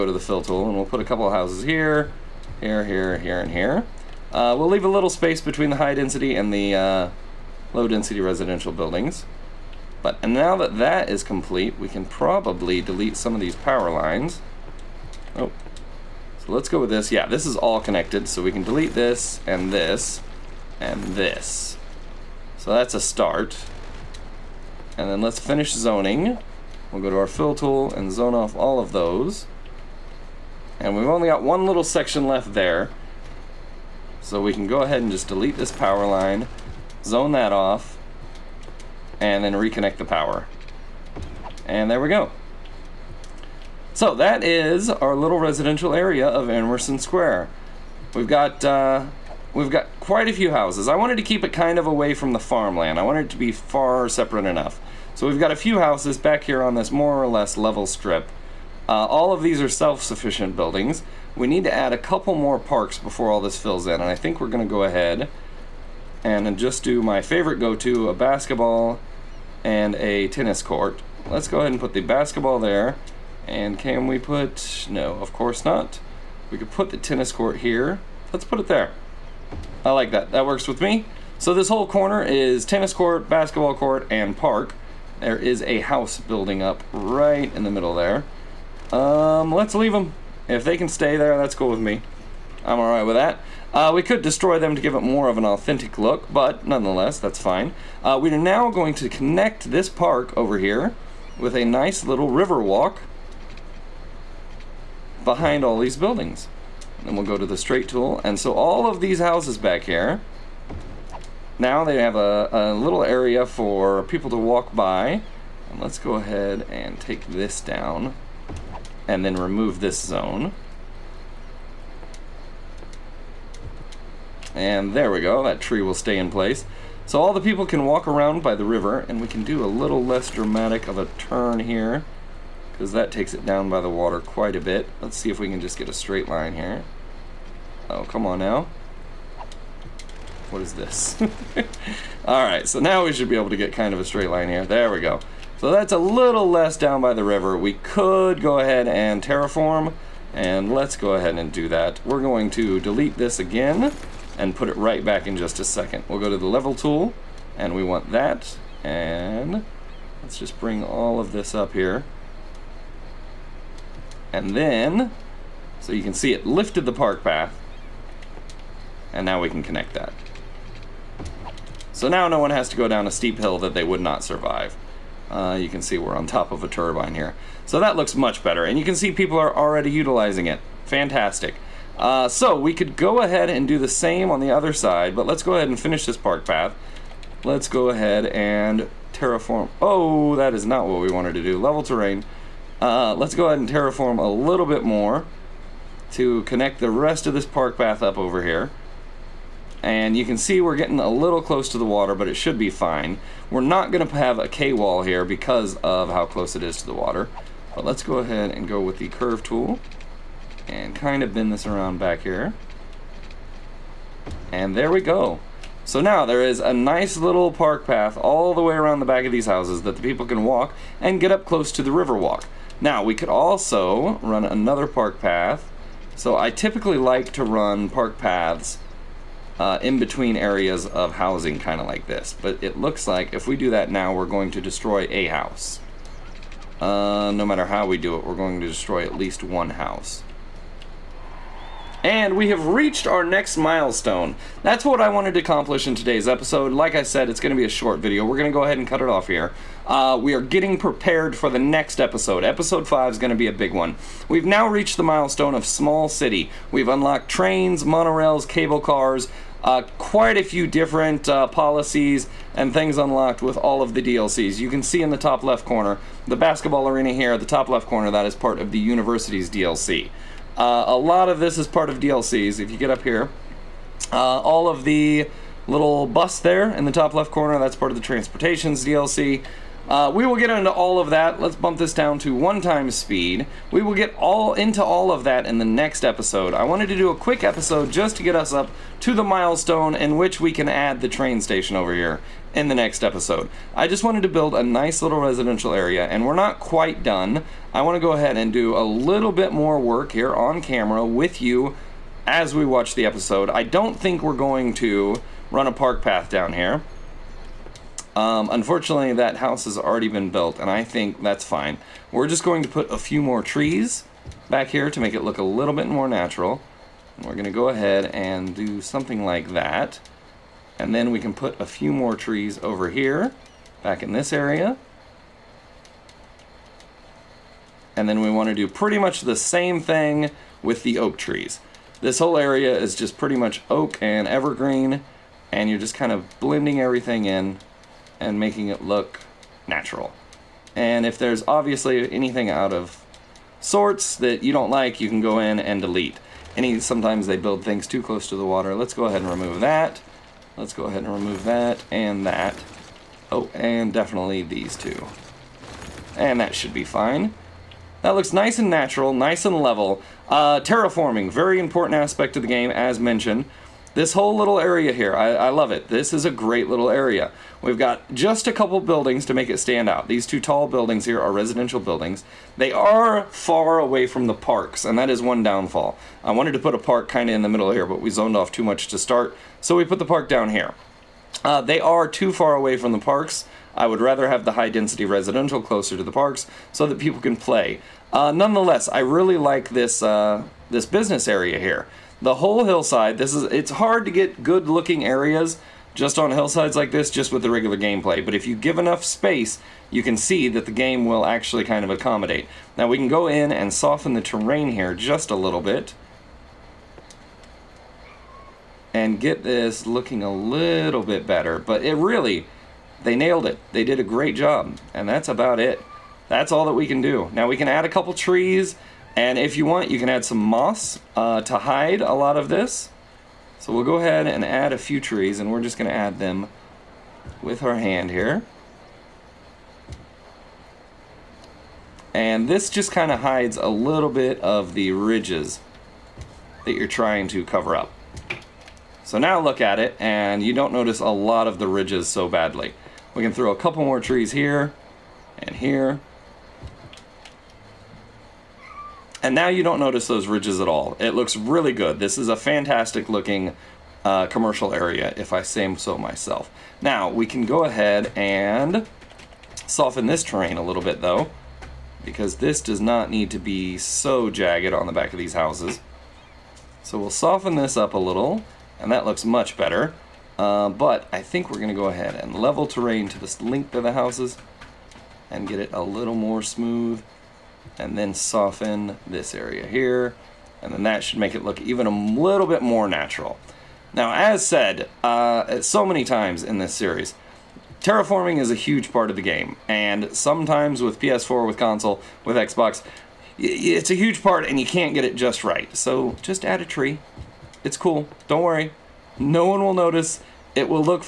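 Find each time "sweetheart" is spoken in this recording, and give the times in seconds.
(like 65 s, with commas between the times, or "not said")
not said.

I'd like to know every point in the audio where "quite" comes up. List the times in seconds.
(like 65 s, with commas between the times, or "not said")
49 s, 134 s, 259 s, 296 s.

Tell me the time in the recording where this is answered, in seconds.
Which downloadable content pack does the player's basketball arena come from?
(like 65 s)
268 s.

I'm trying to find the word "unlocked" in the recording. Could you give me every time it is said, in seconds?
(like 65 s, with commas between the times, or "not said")
256 s, 262 s.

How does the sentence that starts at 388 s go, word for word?
Uh, nonetheless, I really like this, uh, this business area here the whole hillside.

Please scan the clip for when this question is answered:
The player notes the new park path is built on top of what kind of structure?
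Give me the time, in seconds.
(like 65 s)
176 s.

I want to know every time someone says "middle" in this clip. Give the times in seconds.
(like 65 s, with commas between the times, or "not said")
87 s, 377 s.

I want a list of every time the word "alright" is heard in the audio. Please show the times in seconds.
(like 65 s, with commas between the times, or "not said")
92 s, 142 s.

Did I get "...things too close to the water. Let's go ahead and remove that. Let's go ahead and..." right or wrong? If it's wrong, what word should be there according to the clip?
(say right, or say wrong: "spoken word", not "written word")
right.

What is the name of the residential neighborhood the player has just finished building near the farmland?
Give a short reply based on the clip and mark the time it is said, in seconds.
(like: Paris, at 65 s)
Emerson Square, at 46 s.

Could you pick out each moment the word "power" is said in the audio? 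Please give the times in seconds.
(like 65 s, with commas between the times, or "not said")
13 s, 35 s, 40 s.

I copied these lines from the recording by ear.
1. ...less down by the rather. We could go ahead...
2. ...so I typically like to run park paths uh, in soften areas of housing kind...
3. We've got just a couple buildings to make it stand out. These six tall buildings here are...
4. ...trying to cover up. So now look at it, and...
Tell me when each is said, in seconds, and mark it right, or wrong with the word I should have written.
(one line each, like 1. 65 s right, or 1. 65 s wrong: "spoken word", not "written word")
1. 146 s wrong: "river", not "rather"
2. 226 s wrong: "between", not "soften"
3. 367 s wrong: "two", not "six"
4. 436 s right.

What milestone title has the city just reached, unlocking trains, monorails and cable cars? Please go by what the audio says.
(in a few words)
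Small City.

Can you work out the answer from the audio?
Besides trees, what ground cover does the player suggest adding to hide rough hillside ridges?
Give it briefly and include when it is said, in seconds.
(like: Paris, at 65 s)
moss, at 420 s.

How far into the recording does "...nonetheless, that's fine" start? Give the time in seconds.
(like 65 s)
96 s.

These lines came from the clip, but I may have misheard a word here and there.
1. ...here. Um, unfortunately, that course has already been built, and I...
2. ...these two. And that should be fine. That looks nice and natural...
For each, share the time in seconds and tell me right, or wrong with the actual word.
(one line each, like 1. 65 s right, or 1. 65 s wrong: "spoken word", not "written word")
1. 306 s wrong: "house", not "course"
2. 354 s right.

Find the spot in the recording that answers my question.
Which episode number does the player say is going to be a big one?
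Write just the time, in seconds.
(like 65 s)
252 s.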